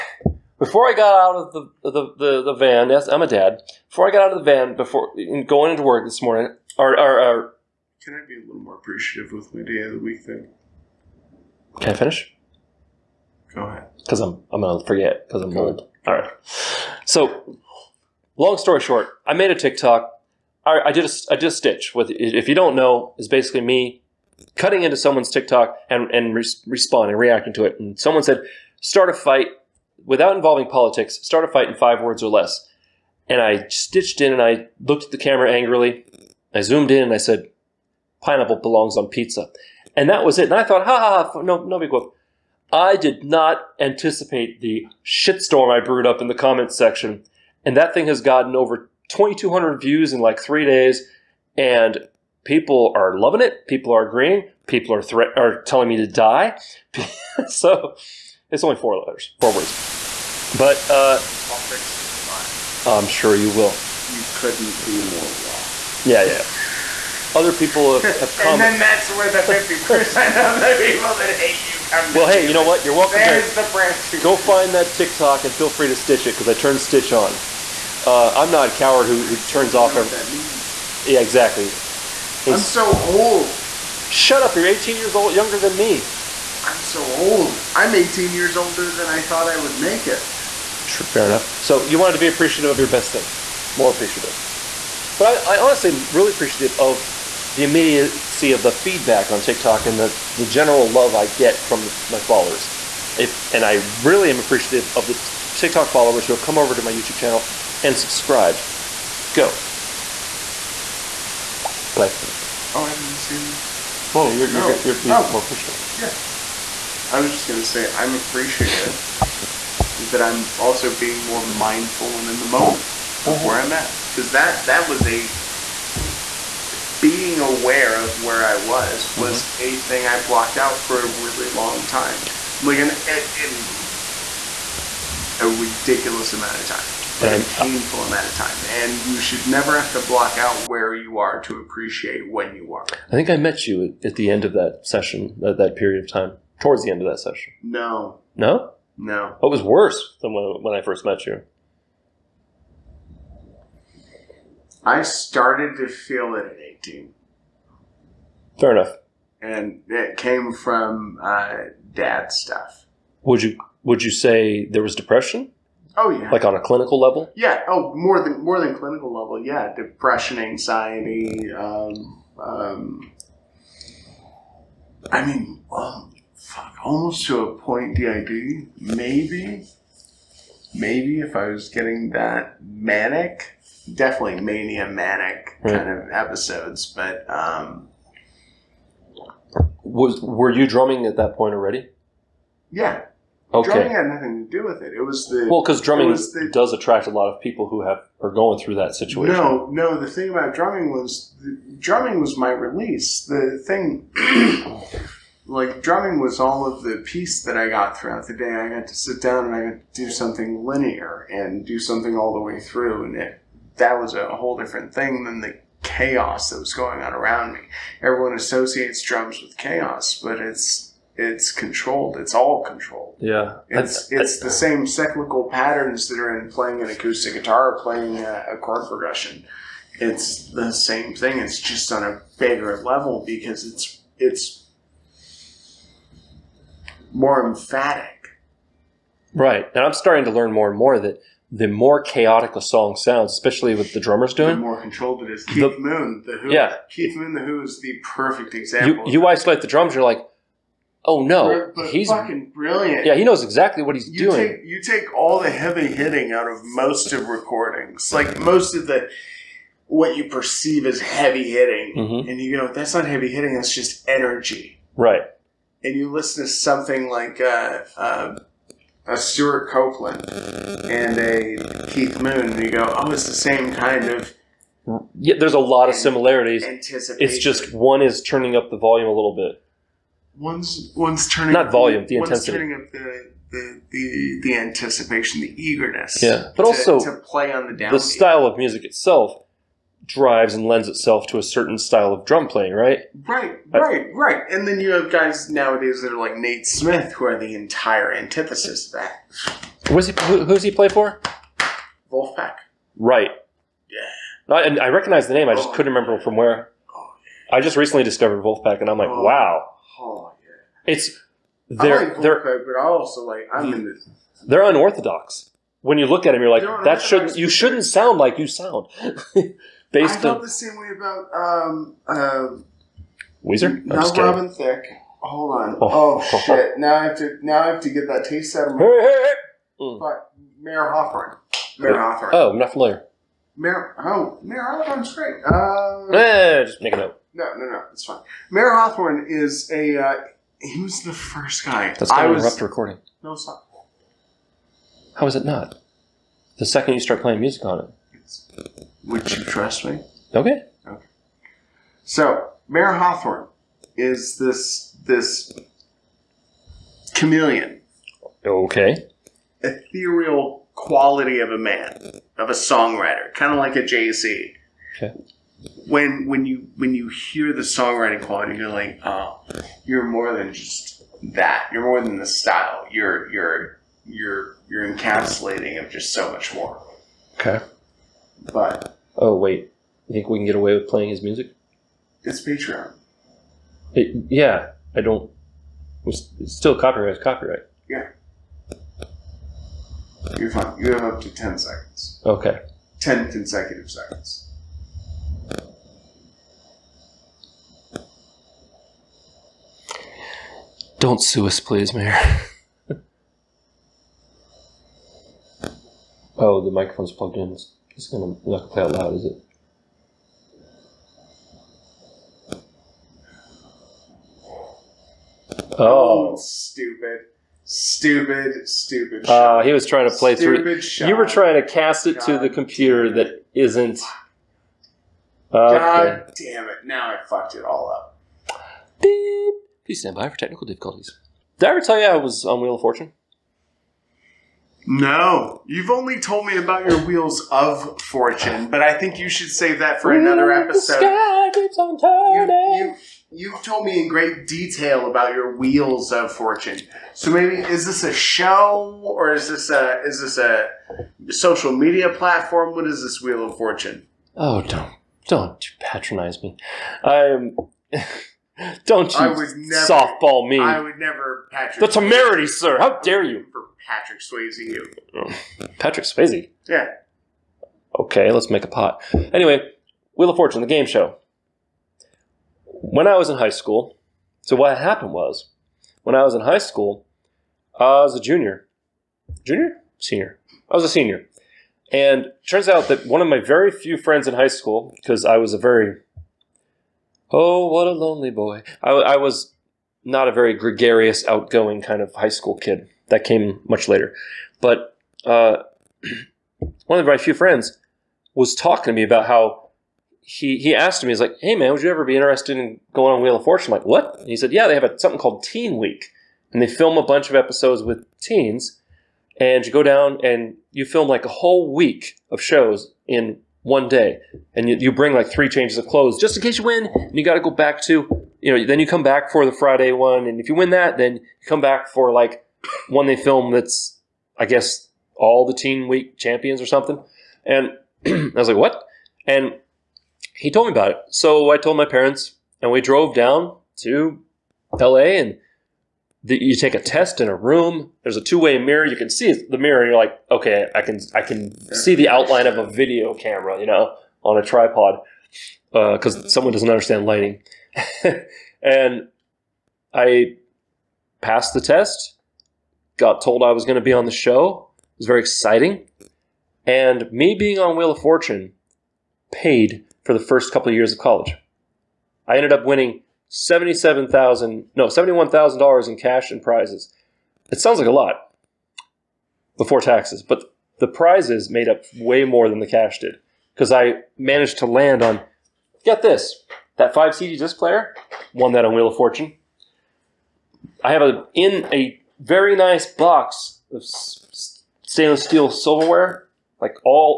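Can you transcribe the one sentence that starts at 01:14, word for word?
Go find that TikTok and feel free to stitch it because I turned Stitch on.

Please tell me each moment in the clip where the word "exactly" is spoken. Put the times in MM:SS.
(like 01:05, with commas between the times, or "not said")
01:21, 04:13.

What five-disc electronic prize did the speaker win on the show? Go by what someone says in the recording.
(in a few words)
CD disc player.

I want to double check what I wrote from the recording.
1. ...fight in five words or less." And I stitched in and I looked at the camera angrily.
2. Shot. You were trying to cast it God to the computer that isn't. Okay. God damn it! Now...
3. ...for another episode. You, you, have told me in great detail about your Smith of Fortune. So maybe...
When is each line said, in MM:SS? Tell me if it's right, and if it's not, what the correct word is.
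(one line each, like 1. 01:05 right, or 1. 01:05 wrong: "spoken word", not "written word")
1. 00:31 right
2. 07:00 right
3. 07:20 wrong: "Wheels", not "Smith".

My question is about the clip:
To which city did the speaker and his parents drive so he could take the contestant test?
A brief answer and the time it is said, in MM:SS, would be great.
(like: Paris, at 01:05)
LA, at 08:54.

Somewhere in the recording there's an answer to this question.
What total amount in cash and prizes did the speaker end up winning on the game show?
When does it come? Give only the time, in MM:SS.
09:24.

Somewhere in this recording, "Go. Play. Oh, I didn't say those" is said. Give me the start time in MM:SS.
01:49.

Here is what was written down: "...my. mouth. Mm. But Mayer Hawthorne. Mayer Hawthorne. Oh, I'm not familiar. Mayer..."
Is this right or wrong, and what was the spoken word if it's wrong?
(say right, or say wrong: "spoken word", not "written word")
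right.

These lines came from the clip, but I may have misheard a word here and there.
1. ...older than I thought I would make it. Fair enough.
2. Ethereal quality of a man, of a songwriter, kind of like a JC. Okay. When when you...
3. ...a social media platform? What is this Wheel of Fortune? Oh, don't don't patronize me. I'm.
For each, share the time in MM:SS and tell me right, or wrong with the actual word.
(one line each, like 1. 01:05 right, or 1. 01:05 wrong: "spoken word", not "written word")
1. 01:28 right
2. 05:59 right
3. 07:30 right.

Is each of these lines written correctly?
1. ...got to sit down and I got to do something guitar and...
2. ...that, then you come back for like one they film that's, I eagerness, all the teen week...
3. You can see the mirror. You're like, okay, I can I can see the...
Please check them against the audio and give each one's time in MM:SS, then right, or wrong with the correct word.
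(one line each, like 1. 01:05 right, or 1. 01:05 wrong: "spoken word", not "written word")
1. 03:28 wrong: "linear", not "guitar"
2. 08:40 wrong: "guess", not "eagerness"
3. 08:58 right.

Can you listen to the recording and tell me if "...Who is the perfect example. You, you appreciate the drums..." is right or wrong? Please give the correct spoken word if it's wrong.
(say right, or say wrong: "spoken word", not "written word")
wrong: "isolate", not "appreciate".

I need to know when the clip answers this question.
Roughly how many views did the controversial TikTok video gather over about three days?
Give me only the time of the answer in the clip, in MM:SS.
00:49.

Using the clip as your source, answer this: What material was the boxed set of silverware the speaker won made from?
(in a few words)
Stainless steel.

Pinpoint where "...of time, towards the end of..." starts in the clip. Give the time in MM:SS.
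02:26.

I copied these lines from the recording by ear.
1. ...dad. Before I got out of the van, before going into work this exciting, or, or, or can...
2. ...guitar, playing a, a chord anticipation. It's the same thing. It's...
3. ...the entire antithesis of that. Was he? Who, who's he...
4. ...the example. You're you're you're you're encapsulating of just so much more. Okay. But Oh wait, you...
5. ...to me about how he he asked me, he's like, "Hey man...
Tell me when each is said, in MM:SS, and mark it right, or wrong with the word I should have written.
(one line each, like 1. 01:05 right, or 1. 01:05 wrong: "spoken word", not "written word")
1. 00:03 wrong: "morning", not "exciting"
2. 03:47 wrong: "progression", not "anticipation"
3. 04:57 right
4. 06:12 wrong: "style", not "example"
5. 08:18 right.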